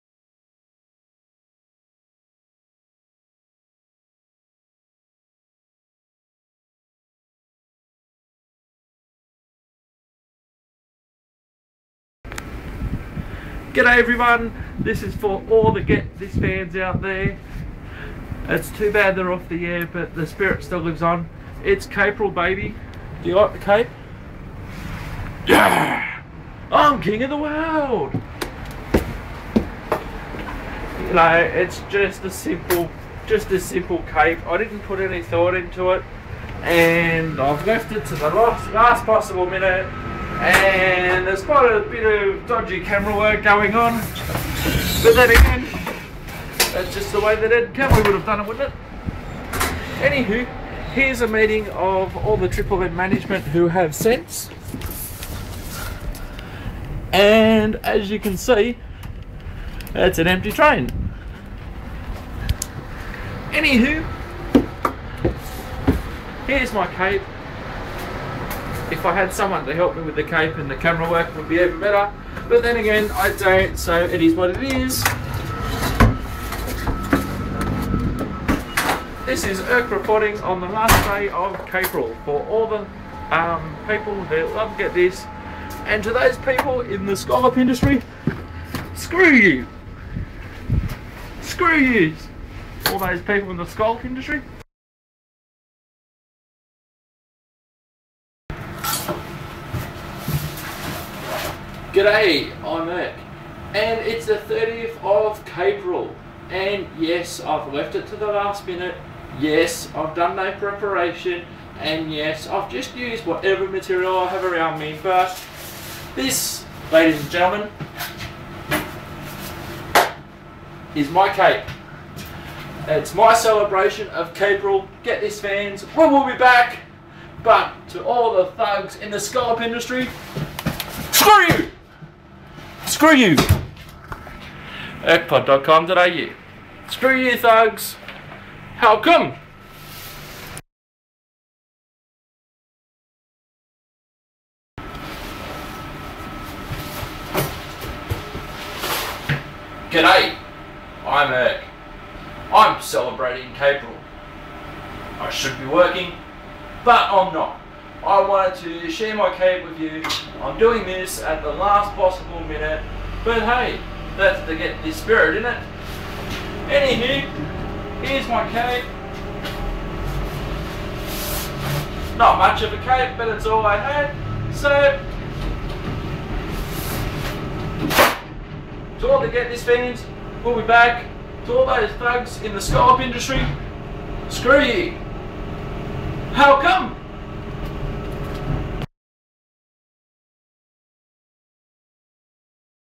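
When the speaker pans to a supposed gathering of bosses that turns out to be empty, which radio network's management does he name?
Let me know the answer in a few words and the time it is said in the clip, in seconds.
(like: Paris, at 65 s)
Triple M, at 52 s.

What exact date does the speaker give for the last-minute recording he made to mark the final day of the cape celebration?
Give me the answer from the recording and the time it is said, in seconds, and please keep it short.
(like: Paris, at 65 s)
30 April, at 104 s.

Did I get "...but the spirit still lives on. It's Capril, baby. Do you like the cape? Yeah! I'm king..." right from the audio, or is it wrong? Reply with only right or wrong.
right.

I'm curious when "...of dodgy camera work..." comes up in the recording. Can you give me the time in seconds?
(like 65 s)
42 s.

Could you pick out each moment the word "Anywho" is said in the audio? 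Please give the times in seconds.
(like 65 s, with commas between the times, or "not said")
49 s, 63 s, 166 s.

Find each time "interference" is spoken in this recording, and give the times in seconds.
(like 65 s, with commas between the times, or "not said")
not said.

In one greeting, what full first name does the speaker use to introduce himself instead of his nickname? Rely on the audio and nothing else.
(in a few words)
Eric.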